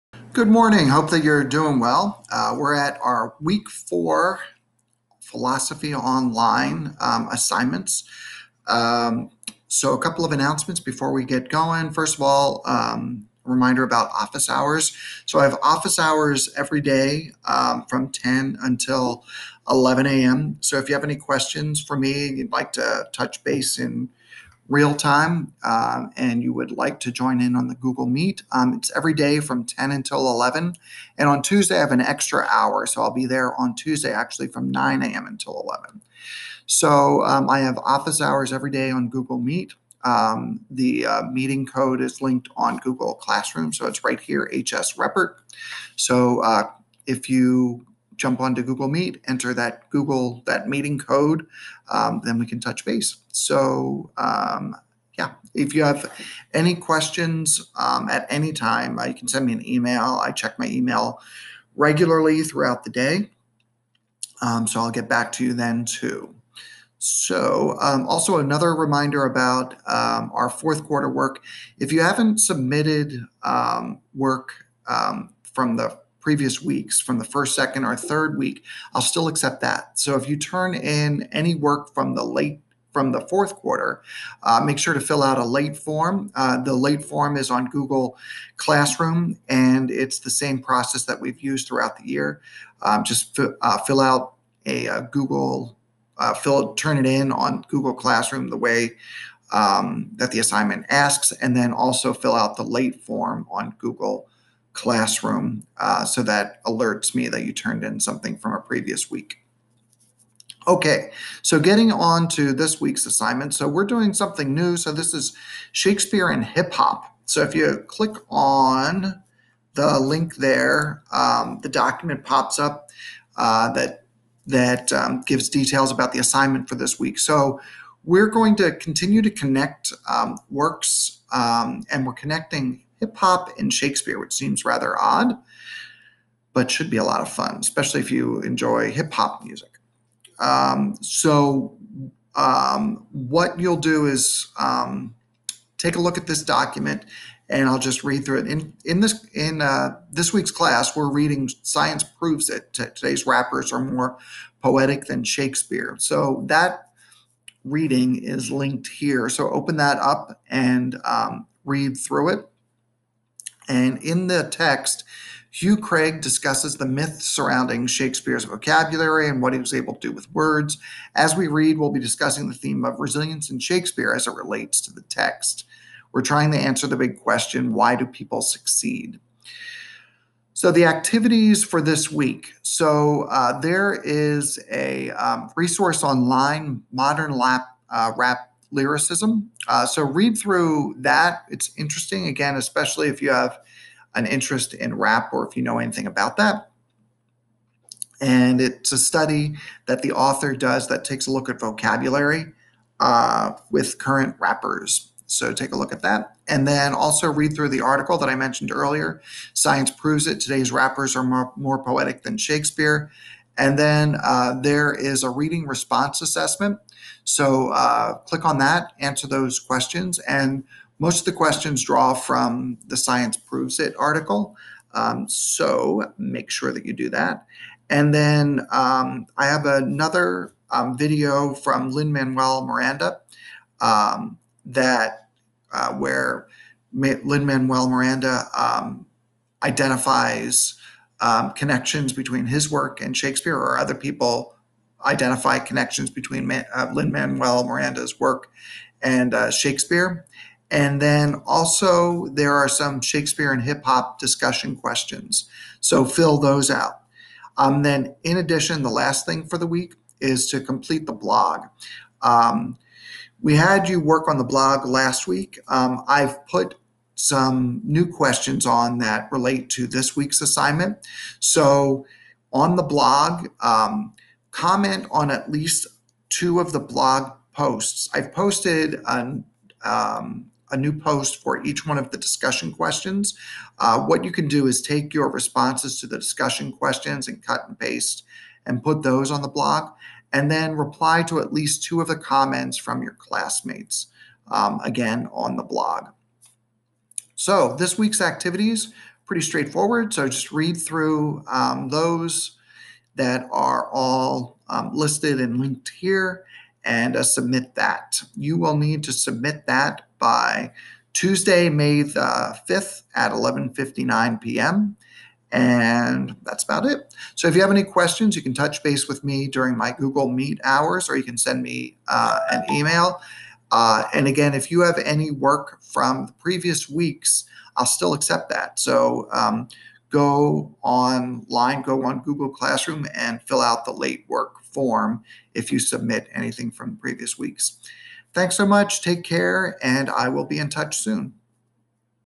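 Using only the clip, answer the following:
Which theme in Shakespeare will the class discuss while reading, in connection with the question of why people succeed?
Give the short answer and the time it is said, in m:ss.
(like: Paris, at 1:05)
resilience, at 2:52.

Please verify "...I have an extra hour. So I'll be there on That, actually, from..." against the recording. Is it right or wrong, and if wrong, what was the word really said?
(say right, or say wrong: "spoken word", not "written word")
wrong: "Tuesday", not "That".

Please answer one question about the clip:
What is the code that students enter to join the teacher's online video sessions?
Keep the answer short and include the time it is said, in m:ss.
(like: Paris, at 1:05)
HS Reppert, at 0:44.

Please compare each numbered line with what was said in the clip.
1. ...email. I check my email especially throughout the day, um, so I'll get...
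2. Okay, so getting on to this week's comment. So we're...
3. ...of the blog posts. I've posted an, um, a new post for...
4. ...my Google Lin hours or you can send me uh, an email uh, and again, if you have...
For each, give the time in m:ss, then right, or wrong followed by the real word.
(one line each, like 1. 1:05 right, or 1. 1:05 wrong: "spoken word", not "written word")
1. 0:59 wrong: "regularly", not "especially"
2. 1:50 wrong: "assignment", not "comment"
3. 4:36 right
4. 5:19 wrong: "Meet", not "Lin".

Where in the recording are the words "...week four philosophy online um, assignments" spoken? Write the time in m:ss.
0:03.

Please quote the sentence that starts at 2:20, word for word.
Um, so, um, what you'll do is um, take a look at this document, and I'll just read through it.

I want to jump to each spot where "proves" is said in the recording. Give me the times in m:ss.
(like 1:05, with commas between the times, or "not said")
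2:32, 3:29, 3:43.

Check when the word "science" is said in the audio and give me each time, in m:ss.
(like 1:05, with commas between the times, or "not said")
2:31, 3:29, 3:42.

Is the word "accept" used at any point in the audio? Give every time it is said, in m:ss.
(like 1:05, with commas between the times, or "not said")
1:19, 5:28.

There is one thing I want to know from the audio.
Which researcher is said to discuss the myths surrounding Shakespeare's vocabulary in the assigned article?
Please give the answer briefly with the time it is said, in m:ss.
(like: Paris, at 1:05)
Hugh Craig, at 2:45.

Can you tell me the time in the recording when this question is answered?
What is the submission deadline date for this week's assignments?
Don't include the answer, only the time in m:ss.
5:11.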